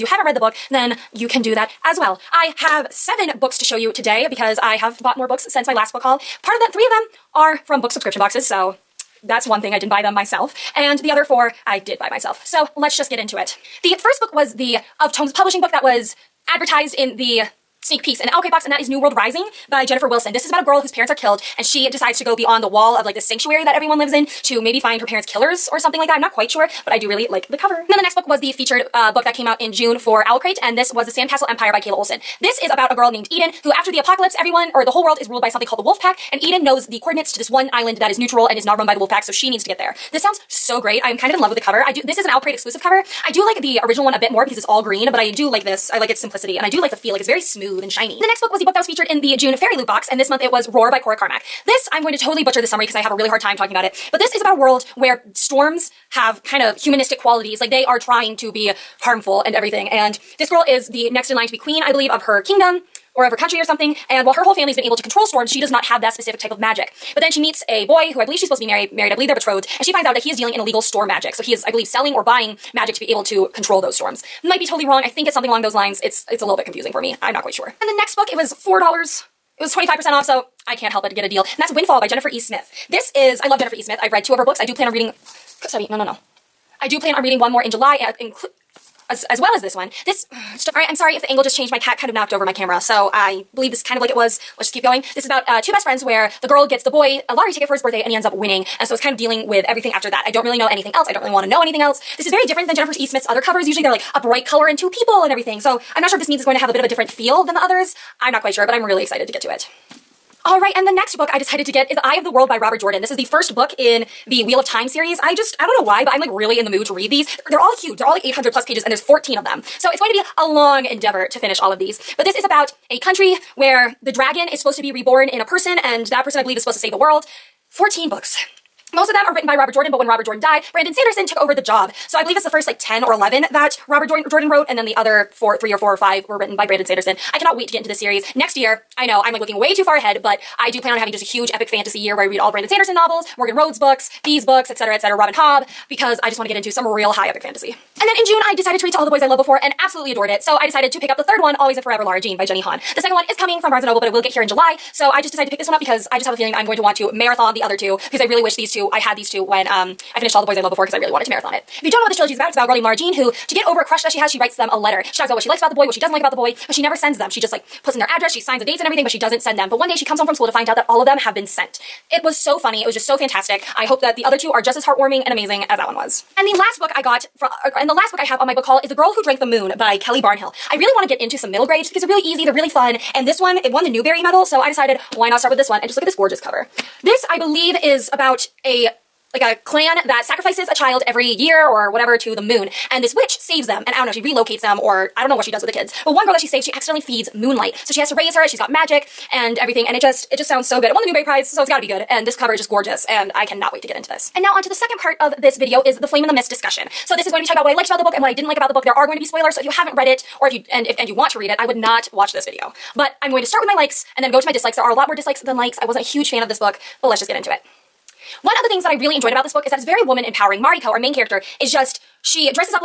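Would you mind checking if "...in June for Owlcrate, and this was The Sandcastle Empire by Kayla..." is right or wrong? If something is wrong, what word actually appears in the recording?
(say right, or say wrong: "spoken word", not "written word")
right.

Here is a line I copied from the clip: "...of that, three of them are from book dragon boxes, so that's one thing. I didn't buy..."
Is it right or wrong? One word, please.
wrong.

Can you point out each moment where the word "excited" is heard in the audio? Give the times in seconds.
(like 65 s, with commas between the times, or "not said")
109 s.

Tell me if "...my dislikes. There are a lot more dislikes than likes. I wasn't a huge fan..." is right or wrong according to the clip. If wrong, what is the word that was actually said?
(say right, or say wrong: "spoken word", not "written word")
right.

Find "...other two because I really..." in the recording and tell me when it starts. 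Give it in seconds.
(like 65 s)
157 s.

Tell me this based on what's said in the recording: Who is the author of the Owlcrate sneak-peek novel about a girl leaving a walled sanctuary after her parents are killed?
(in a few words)
Jennifer Wilson.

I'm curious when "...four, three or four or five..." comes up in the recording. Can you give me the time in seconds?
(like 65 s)
135 s.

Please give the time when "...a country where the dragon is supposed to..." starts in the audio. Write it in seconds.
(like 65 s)
122 s.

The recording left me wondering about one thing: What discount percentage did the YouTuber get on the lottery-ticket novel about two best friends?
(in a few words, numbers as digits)
25%.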